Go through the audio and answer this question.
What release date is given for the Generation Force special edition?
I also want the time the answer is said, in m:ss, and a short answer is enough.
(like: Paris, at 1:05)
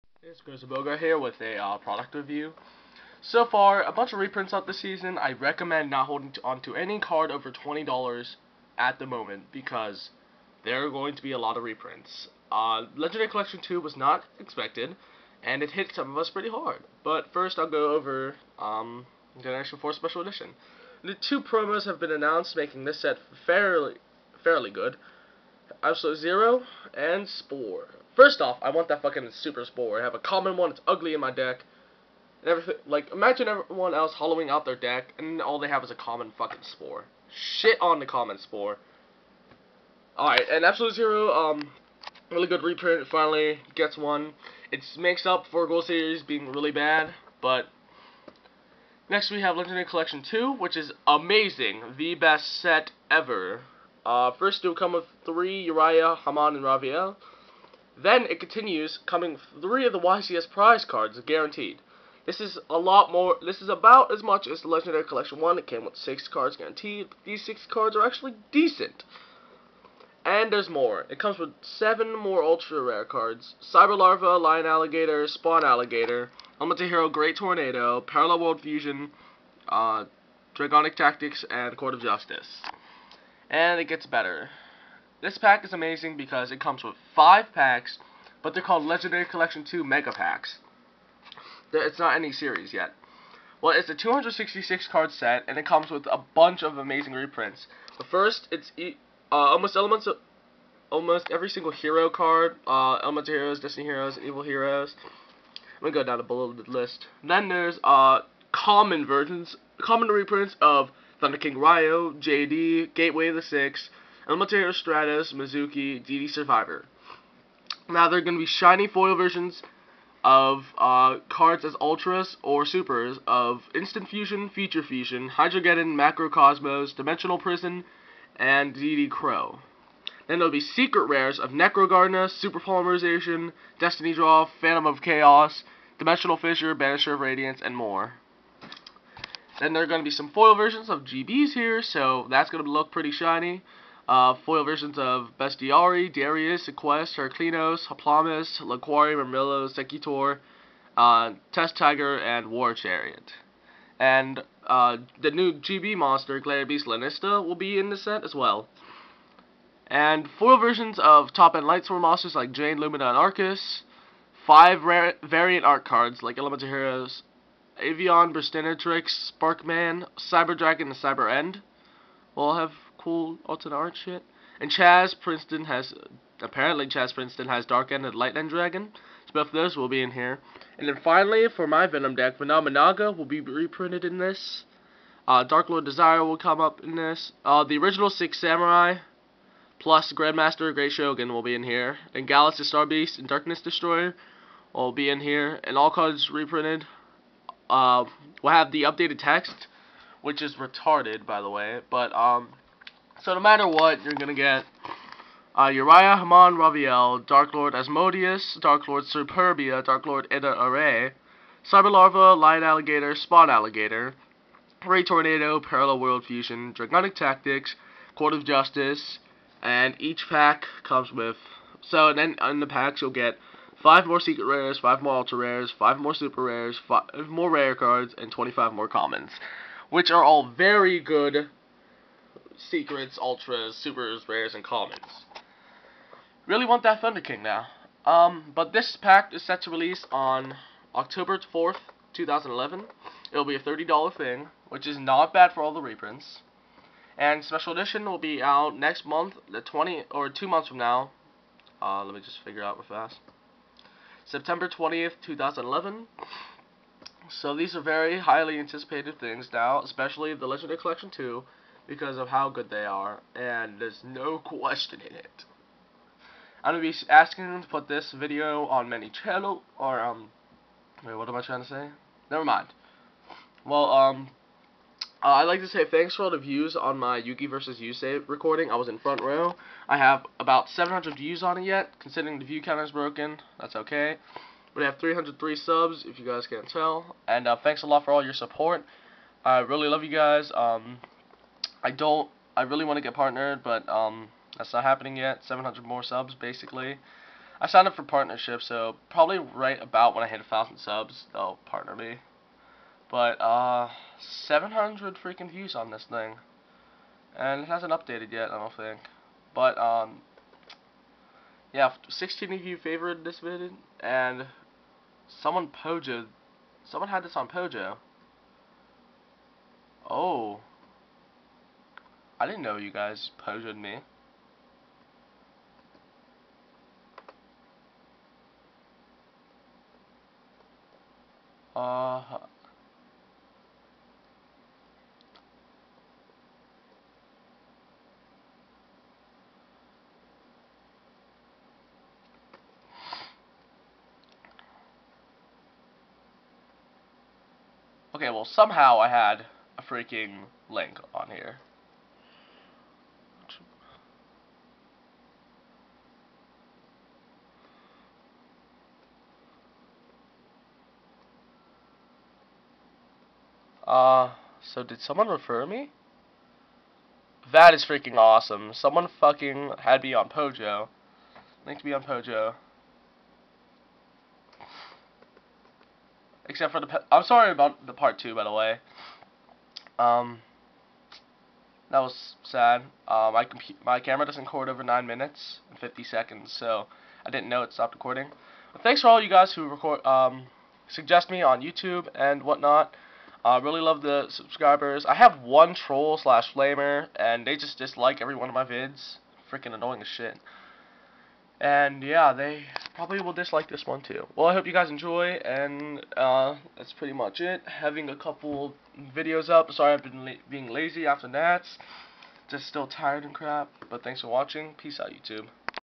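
September 20th, 2011, at 4:14.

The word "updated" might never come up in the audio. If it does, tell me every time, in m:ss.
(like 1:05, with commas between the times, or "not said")
3:18, 5:07.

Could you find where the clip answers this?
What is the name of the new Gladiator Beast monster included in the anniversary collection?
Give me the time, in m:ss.
2:36.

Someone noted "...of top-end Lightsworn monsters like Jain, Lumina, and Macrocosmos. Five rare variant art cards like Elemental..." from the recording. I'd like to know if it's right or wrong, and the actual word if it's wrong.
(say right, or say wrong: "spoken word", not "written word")
wrong: "Aurkus", not "Macrocosmos".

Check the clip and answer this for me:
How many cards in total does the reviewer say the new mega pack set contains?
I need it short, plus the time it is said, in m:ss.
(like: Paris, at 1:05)
266, at 1:33.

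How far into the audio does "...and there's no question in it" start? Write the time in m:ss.
4:23.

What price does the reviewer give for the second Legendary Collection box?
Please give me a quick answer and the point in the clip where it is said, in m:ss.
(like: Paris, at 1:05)
$30, at 4:03.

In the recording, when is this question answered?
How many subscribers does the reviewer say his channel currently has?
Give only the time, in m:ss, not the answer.
4:44.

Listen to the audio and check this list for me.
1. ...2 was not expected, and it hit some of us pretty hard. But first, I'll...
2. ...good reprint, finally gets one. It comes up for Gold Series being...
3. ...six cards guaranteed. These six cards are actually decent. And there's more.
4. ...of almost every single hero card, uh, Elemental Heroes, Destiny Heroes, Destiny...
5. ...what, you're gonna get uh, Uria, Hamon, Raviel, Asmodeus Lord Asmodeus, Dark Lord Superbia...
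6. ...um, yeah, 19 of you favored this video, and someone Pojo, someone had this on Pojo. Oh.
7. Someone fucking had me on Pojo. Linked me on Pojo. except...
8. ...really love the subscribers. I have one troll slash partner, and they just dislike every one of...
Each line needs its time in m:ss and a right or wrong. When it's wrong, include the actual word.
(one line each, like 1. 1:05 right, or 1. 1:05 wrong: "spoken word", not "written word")
1. 0:13 right
2. 0:42 wrong: "makes", not "comes"
3. 1:05 right
4. 1:40 wrong: "Evil", not "Destiny"
5. 3:23 wrong: "Dark", not "Asmodeus"
6. 5:09 wrong: "16", not "19"
7. 6:08 right
8. 6:33 wrong: "flamer", not "partner".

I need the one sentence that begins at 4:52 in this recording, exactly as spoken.
I really want to get partnered, but um, that's not happening yet.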